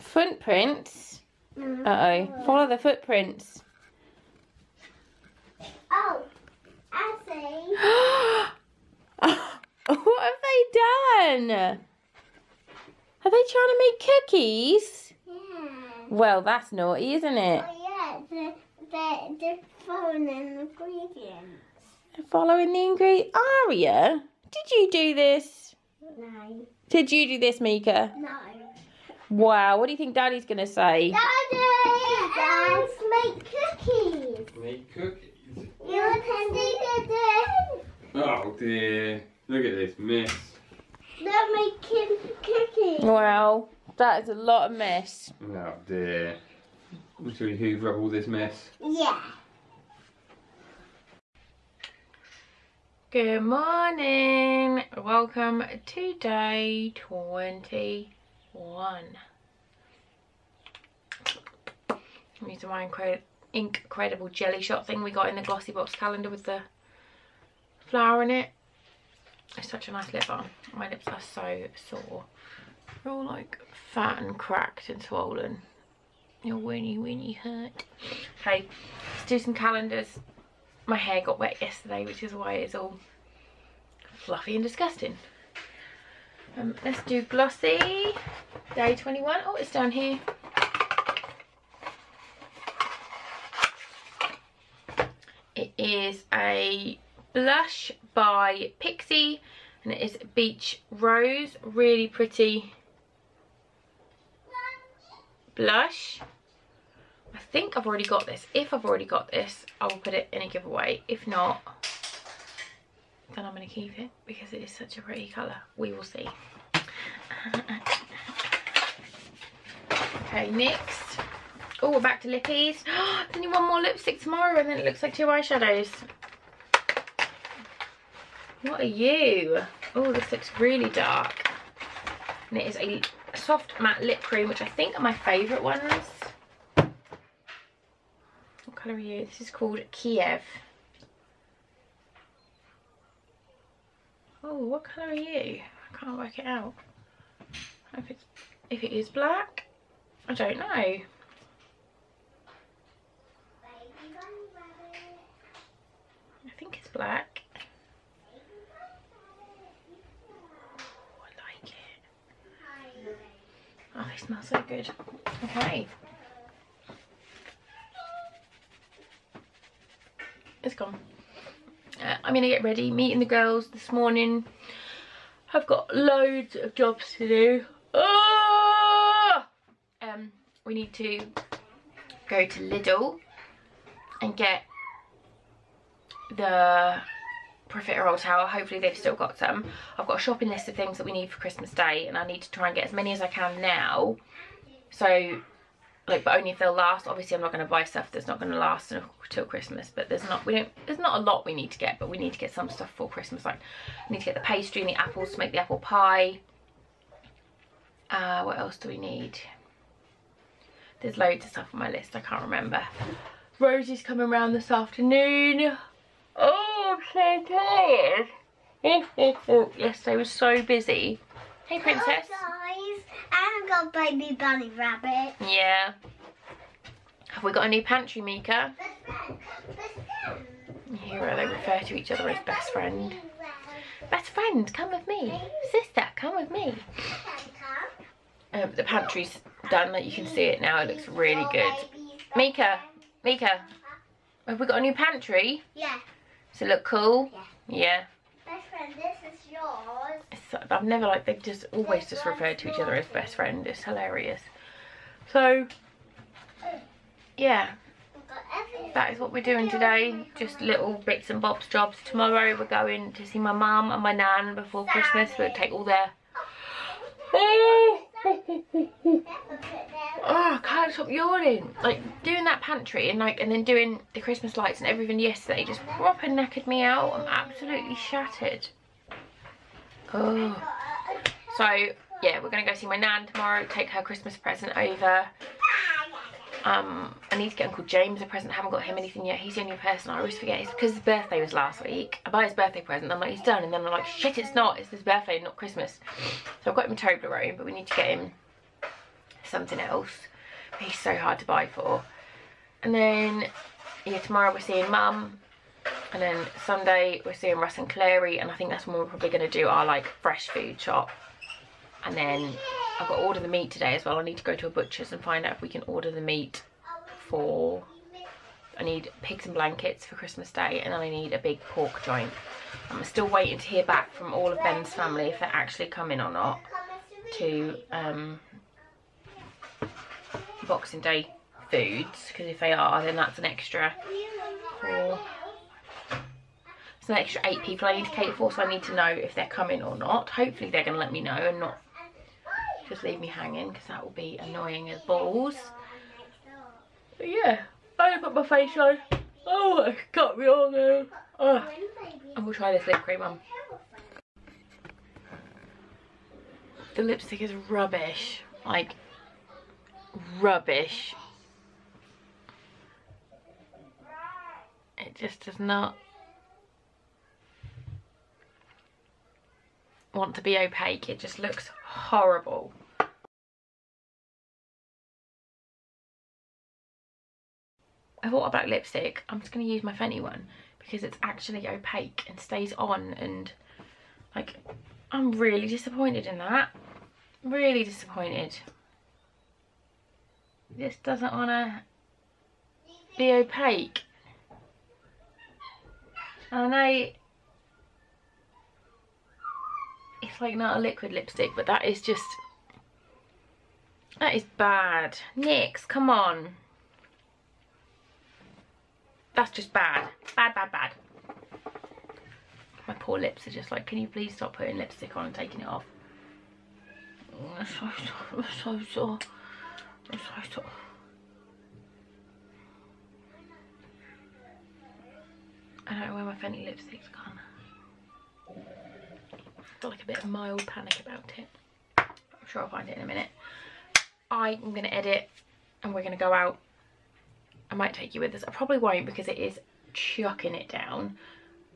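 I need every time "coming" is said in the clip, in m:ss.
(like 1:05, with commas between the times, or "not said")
3:34, 5:25, 5:39.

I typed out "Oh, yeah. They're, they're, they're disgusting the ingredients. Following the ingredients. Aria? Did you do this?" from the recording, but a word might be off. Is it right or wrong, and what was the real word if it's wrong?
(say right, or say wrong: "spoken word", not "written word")
wrong: "following", not "disgusting".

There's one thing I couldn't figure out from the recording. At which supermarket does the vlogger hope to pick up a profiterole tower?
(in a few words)
Lidl.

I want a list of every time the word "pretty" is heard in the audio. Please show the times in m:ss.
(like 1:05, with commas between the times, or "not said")
1:42, 1:55.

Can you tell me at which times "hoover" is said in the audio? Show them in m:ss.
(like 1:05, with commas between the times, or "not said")
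0:47.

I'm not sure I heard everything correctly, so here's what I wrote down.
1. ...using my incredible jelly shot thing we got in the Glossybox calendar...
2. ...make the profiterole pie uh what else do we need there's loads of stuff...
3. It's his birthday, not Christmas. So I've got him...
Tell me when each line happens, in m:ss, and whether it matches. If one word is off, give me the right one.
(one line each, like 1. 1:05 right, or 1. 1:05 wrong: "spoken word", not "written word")
1. 1:02 right
2. 3:25 wrong: "apple", not "profiterole"
3. 4:54 right.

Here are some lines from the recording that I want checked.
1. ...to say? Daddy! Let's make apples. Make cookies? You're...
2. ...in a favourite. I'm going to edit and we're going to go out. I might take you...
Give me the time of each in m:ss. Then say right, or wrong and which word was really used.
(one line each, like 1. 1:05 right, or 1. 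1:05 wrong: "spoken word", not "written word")
1. 0:30 wrong: "cookies", not "apples"
2. 7:12 wrong: "minute", not "favourite".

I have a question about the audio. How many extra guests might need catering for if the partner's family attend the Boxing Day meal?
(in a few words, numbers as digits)
8.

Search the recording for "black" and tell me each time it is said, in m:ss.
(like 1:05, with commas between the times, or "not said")
2:29, 2:36, 6:18.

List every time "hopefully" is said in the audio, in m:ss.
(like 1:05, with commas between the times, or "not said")
3:08, 5:40.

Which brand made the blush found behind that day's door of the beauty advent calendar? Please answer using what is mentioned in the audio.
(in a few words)
Pixi.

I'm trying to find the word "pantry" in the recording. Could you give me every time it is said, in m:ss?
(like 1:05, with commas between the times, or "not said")
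3:47, 3:58, 4:04, 4:32.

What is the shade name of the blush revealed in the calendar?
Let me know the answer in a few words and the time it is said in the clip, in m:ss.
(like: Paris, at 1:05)
Beach Rose, at 1:40.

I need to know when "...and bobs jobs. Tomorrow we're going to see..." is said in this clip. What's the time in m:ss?
4:21.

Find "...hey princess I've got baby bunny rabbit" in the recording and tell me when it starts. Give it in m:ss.
3:41.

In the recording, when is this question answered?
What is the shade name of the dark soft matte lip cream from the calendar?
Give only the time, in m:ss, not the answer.
2:19.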